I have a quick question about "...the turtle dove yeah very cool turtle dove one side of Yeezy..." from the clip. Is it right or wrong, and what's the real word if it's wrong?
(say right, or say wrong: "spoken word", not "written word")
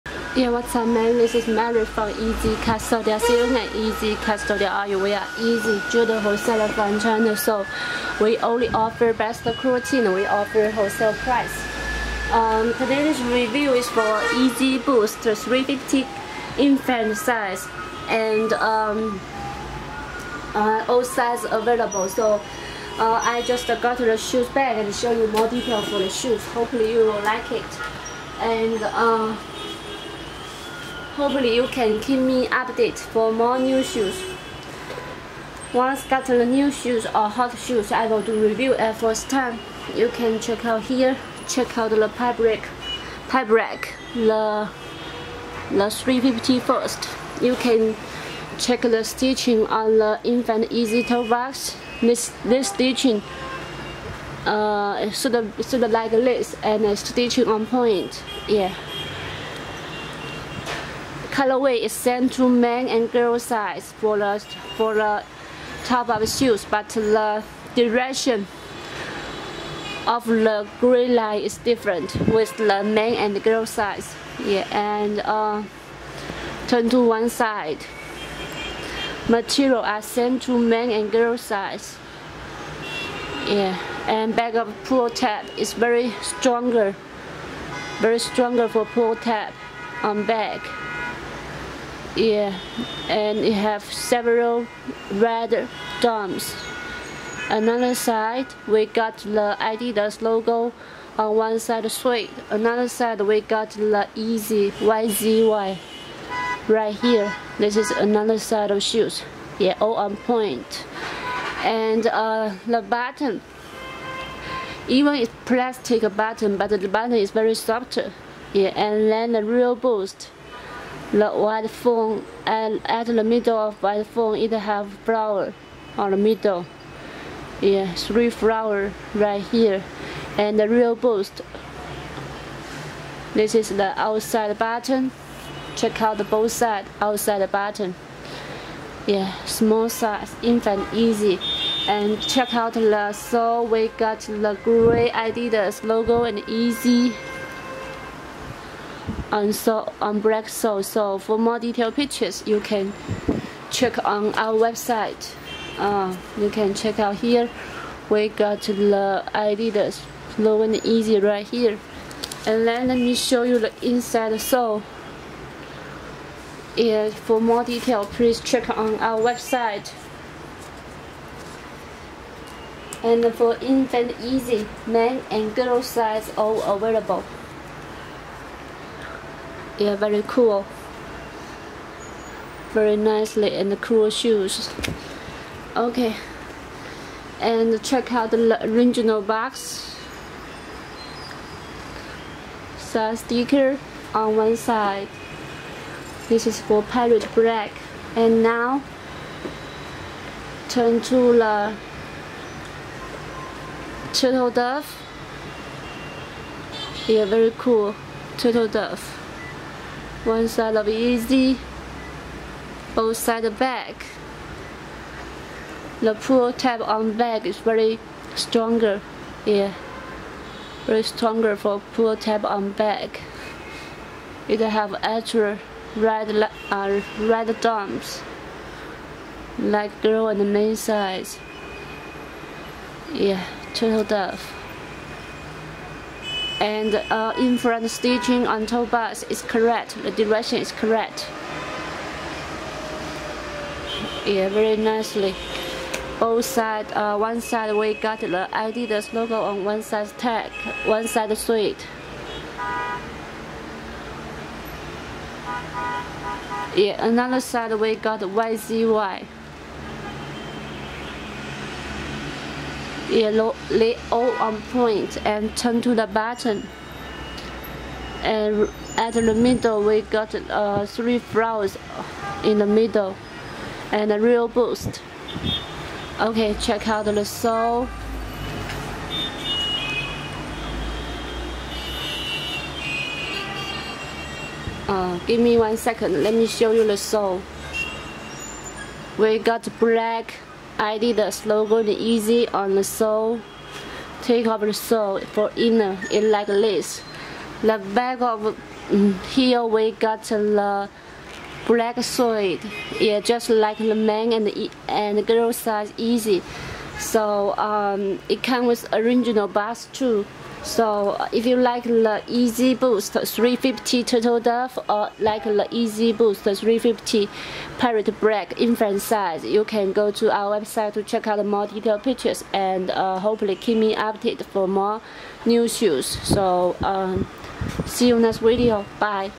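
right.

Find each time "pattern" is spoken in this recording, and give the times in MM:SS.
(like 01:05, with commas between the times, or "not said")
not said.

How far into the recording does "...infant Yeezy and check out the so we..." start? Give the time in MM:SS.
02:20.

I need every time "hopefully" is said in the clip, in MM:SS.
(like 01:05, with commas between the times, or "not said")
00:26, 00:31, 05:23.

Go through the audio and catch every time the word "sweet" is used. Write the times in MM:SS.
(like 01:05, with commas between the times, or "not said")
04:11.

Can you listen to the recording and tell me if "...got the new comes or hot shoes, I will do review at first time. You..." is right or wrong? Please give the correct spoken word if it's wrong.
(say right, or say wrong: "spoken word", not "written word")
wrong: "shoes", not "comes".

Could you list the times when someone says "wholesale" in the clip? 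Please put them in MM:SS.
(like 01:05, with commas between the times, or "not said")
00:06, 00:10.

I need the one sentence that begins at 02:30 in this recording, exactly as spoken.
So for more detailed pictures, you can check on our website.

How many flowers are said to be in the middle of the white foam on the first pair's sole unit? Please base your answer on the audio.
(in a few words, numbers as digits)
3.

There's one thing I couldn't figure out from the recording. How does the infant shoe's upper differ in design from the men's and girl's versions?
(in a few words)
direction of the gray line.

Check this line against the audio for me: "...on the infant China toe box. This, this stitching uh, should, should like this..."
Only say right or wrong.
wrong.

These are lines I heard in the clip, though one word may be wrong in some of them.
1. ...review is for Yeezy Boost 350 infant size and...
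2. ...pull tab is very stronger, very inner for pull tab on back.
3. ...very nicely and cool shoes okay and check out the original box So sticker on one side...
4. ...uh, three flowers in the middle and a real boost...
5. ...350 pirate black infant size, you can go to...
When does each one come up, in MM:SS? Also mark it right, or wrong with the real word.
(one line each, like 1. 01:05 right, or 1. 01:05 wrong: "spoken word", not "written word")
1. 00:13 right
2. 01:24 wrong: "stronger", not "inner"
3. 03:02 right
4. 04:30 right
5. 05:16 right.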